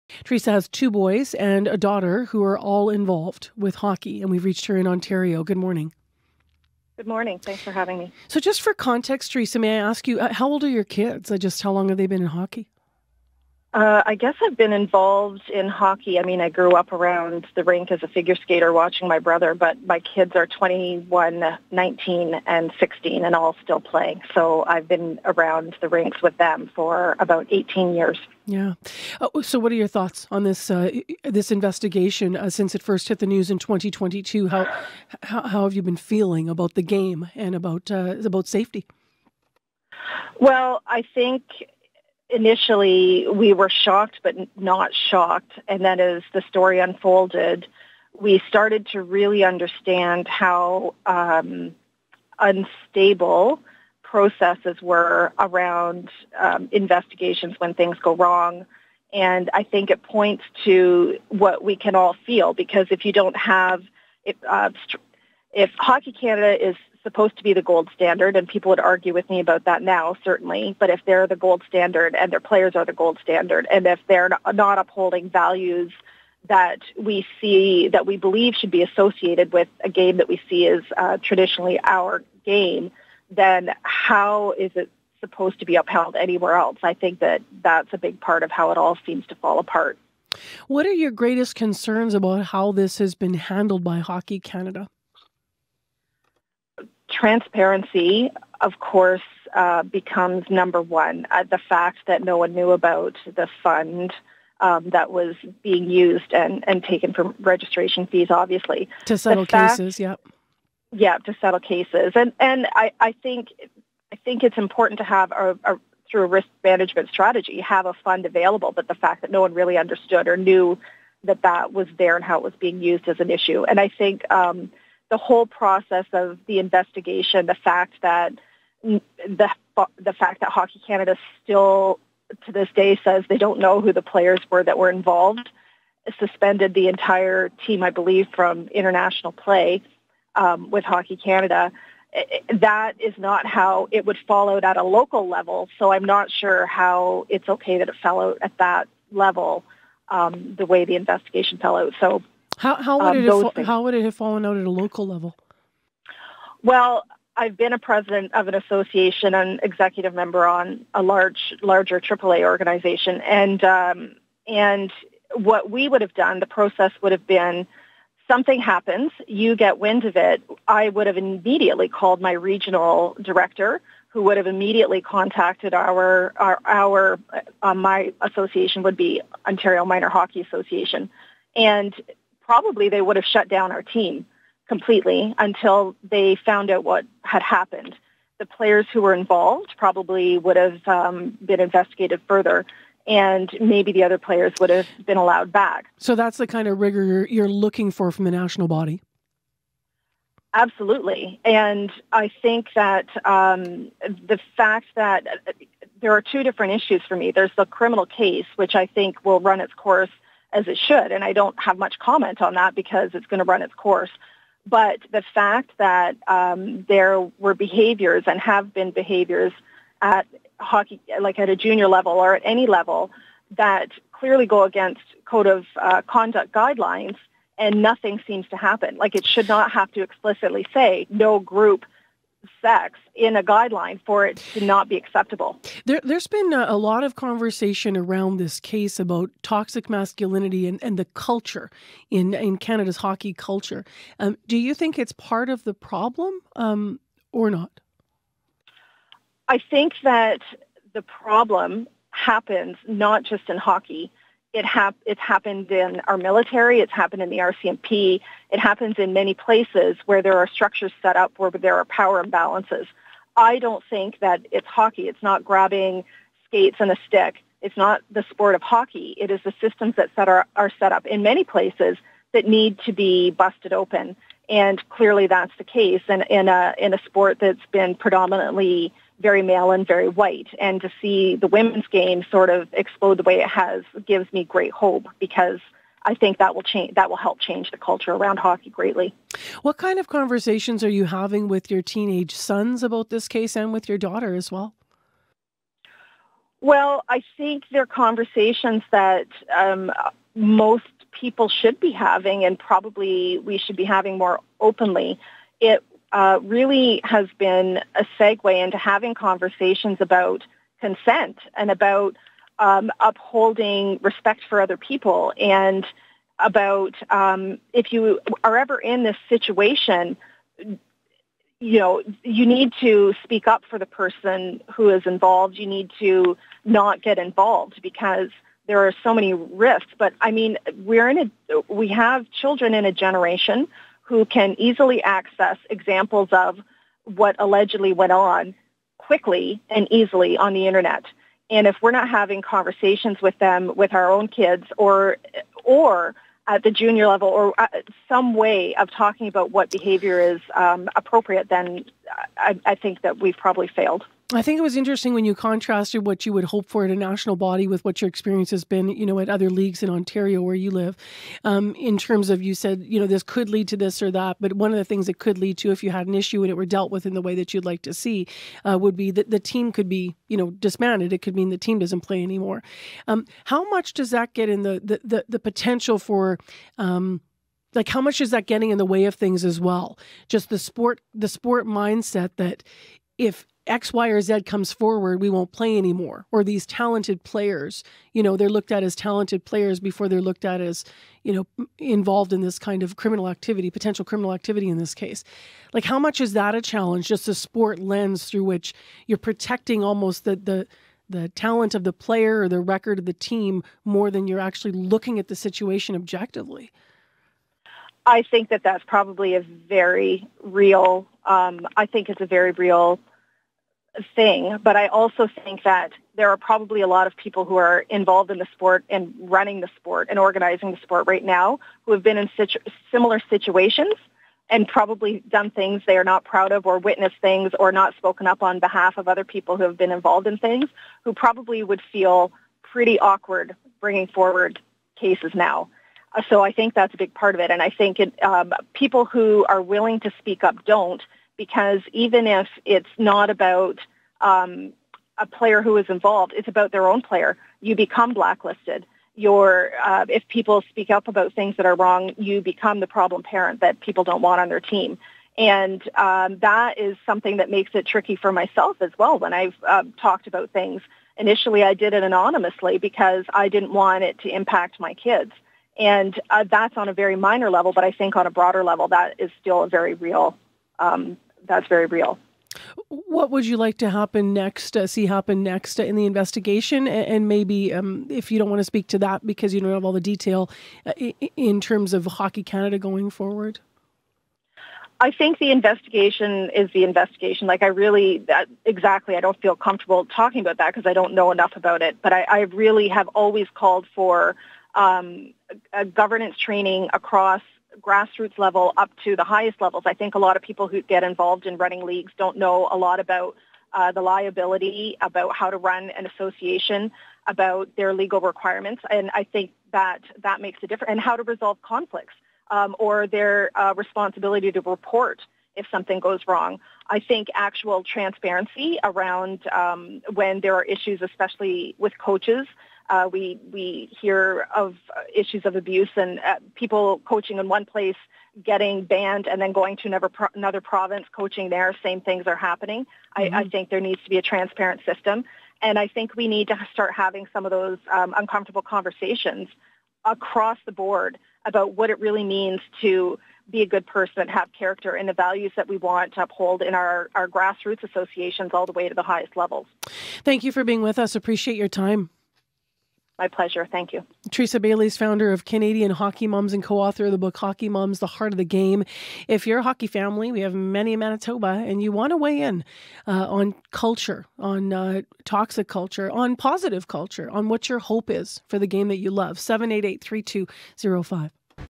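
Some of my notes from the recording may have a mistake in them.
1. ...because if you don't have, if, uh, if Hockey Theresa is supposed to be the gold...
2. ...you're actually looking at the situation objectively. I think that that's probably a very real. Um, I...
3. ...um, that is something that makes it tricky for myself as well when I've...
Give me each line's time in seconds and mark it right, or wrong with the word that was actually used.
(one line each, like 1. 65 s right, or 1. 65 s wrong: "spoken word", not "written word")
1. 62 s wrong: "Canada", not "Theresa"
2. 404 s right
3. 455 s right.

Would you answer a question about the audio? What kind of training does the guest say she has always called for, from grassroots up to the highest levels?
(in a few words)
Governance training.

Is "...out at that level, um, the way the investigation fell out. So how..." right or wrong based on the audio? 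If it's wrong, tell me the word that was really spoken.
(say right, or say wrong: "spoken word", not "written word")
right.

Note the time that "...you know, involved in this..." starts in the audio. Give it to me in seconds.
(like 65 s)
391 s.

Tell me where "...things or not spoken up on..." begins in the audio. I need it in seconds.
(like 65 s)
427 s.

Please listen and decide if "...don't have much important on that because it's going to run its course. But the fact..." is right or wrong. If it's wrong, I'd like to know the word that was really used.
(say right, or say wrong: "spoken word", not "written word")
wrong: "comment", not "important".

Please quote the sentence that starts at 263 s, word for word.
I don't think that it's hockey.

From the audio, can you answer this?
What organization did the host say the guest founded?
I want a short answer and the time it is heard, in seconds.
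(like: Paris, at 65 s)
Canadian Hockey Moms, at 555 s.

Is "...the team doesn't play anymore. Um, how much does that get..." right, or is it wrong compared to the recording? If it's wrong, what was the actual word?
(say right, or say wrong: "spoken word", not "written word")
right.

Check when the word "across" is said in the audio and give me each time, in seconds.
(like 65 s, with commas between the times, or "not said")
496 s, 540 s.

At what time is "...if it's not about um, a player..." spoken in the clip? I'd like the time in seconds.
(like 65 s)
442 s.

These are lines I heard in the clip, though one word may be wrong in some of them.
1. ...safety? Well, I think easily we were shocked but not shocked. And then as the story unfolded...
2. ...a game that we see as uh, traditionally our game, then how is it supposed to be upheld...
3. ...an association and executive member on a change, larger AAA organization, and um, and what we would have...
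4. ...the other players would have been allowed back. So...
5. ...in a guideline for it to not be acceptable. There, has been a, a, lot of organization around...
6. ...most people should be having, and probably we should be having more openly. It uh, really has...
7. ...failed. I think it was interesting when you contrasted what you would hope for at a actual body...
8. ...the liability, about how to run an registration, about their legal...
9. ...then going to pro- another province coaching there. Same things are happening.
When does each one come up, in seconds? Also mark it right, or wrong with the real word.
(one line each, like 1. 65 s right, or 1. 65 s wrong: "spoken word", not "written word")
1. 38 s wrong: "initially", not "easily"
2. 79 s right
3. 158 s wrong: "large", not "change"
4. 193 s right
5. 233 s wrong: "conversation", not "organization"
6. 300 s right
7. 353 s wrong: "national", not "actual"
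8. 503 s wrong: "association", not "registration"
9. 529 s right.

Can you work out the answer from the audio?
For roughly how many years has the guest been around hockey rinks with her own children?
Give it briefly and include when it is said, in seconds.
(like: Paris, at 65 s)
18 years, at 27 s.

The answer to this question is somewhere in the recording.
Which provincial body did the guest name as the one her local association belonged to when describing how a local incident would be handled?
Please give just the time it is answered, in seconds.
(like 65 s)
179 s.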